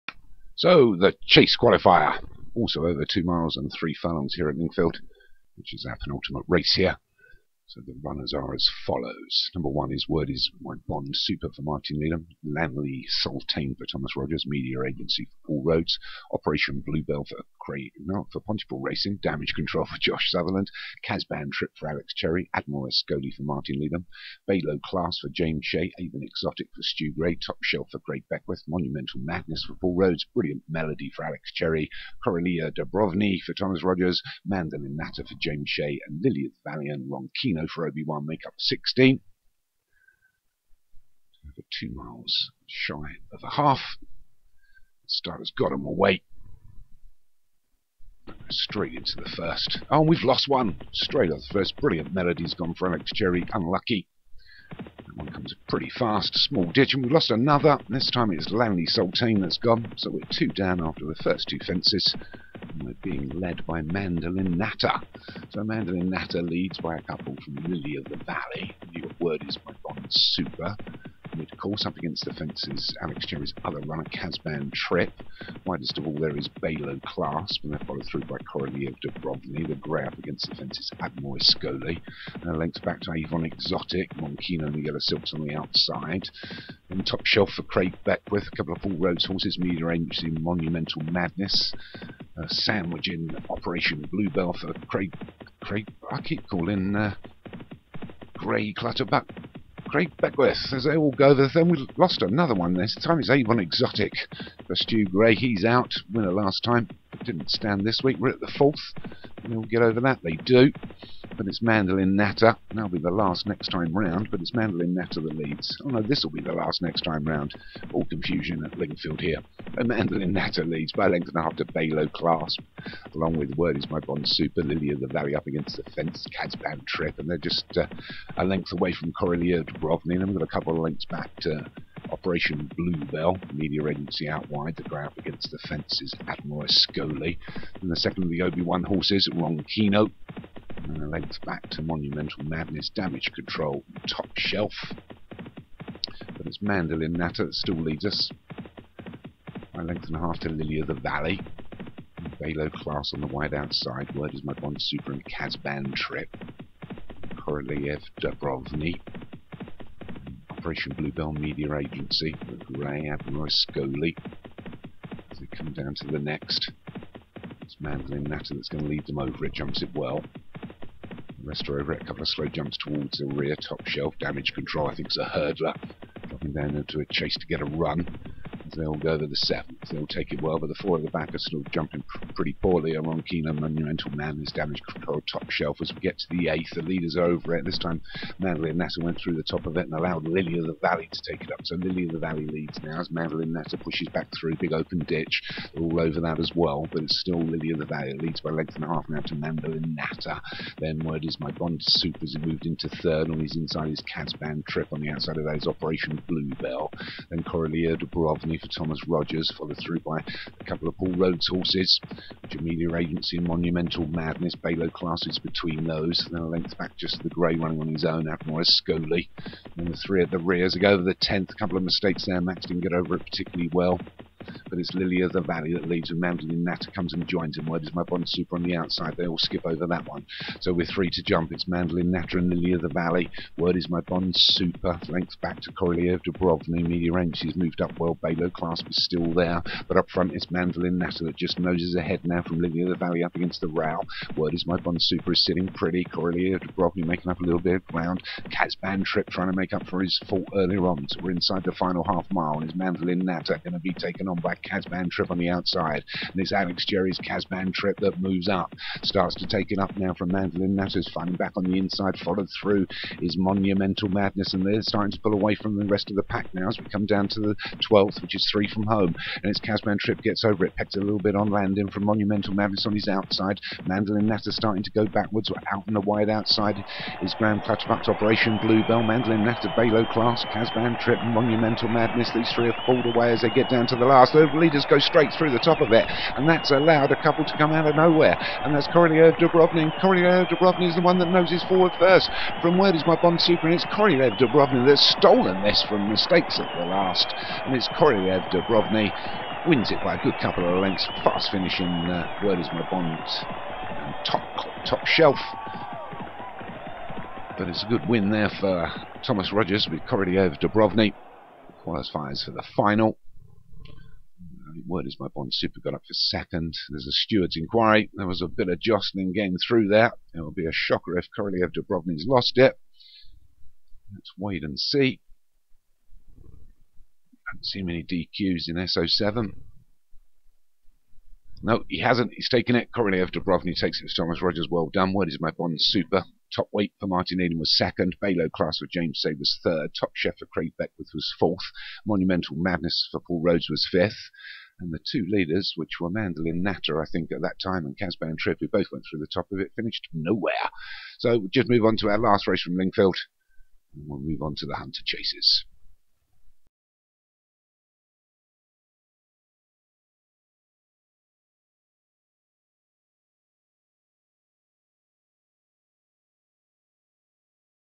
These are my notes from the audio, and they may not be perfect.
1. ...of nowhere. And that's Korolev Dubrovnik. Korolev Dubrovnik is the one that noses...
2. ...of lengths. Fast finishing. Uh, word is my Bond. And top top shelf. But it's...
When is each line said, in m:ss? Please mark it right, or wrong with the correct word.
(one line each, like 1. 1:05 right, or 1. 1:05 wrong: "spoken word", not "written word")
1. 4:47 right
2. 5:00 right.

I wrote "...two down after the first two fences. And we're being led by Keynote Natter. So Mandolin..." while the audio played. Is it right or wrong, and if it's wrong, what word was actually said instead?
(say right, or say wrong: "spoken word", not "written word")
wrong: "Mandolin", not "Keynote".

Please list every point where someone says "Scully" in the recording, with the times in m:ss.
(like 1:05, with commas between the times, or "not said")
0:22, 1:21, 2:16, 2:43, 3:38.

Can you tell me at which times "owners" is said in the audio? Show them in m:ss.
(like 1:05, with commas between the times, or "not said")
not said.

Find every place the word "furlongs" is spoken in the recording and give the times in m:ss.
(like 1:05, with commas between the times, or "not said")
0:03.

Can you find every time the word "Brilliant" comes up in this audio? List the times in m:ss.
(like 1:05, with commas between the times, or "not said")
0:30, 0:51.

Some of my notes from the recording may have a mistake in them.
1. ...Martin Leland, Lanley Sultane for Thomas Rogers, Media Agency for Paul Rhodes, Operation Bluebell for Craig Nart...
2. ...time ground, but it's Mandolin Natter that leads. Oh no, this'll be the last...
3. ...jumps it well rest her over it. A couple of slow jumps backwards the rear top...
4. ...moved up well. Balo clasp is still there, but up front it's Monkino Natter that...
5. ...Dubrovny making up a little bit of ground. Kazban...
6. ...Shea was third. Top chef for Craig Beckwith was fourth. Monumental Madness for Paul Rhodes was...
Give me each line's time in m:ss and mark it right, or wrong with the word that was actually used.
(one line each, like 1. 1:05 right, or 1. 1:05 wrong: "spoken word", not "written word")
1. 0:11 right
2. 1:53 wrong: "round", not "ground"
3. 2:49 wrong: "towards", not "backwards"
4. 3:57 wrong: "Mandolin", not "Monkino"
5. 4:06 right
6. 5:39 right.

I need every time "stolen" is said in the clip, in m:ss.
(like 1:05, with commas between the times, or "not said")
4:55.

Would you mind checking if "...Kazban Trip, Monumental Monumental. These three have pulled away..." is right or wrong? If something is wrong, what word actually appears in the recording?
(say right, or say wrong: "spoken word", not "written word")
wrong: "Madness", not "Monumental".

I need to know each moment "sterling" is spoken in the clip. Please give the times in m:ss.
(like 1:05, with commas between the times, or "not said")
not said.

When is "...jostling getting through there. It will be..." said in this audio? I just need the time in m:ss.
5:18.